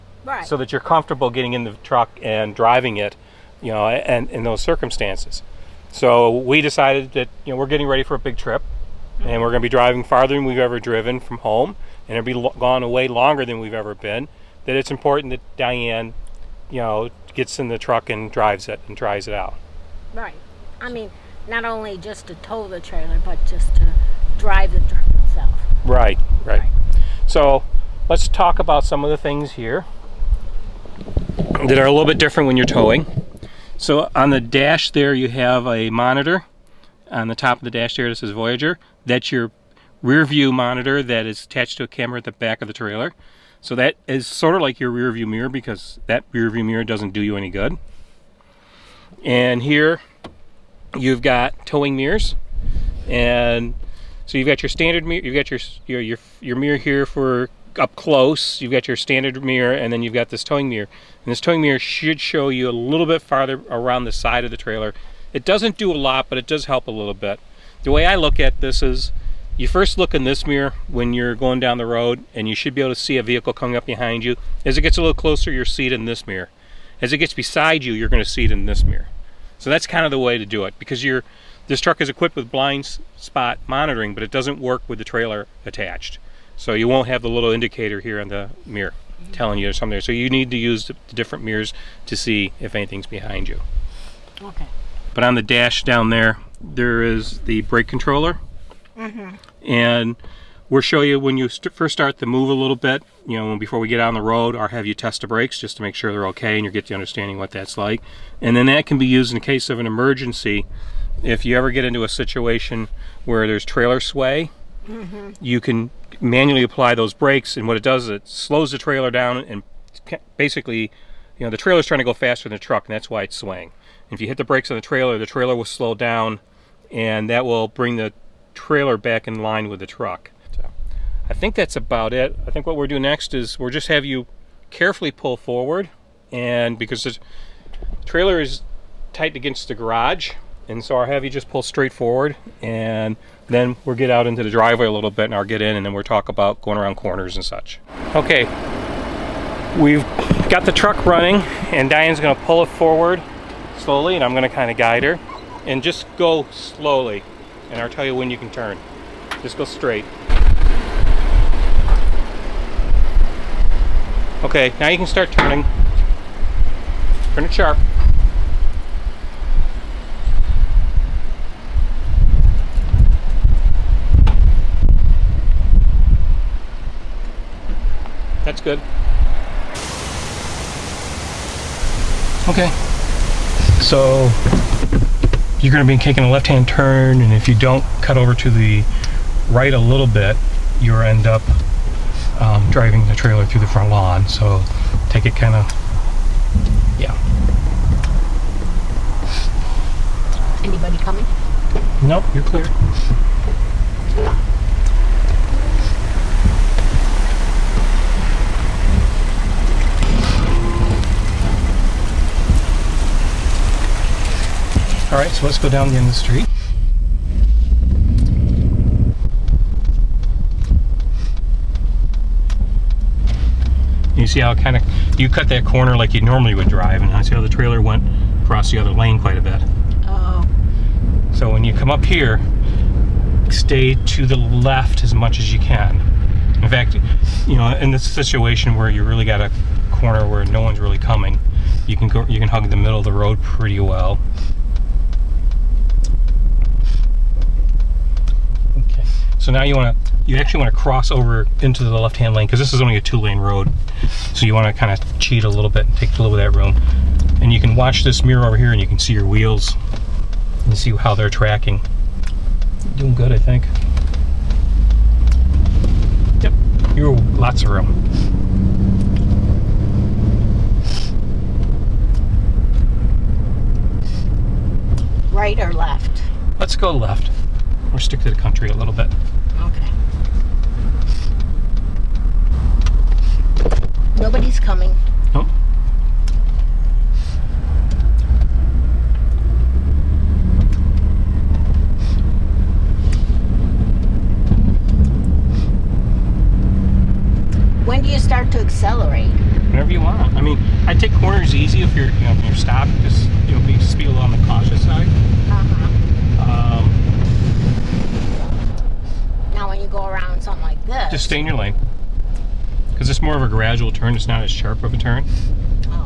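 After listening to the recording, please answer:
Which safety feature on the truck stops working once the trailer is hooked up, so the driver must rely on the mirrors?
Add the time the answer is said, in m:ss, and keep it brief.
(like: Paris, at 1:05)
blind spot monitoring, at 1:22.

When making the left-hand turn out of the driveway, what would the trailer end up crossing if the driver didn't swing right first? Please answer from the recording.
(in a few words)
the front lawn.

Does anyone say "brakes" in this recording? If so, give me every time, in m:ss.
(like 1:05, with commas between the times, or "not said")
1:37, 1:45, 1:57, 2:04.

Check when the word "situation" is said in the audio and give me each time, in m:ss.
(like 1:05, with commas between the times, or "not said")
1:52, 3:58.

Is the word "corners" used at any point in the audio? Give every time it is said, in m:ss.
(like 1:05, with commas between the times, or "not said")
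2:26, 3:45, 3:59, 5:01.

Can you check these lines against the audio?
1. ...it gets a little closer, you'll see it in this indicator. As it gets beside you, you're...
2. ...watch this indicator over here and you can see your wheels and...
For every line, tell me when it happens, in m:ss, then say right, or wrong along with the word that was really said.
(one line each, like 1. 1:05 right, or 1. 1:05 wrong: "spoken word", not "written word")
1. 1:14 wrong: "mirror", not "indicator"
2. 4:17 wrong: "mirror", not "indicator".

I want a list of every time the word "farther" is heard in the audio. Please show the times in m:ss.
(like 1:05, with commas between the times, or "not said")
0:10, 1:03.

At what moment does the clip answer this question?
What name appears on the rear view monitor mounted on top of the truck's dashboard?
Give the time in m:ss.
0:38.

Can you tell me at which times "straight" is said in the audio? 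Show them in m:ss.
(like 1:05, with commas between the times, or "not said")
2:21, 2:39.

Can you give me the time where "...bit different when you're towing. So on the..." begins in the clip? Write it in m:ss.
0:32.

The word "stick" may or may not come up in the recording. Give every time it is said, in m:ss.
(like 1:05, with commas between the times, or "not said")
4:37.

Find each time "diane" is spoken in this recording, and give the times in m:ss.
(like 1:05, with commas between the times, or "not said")
0:15, 2:31.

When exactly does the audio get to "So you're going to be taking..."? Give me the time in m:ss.
3:03.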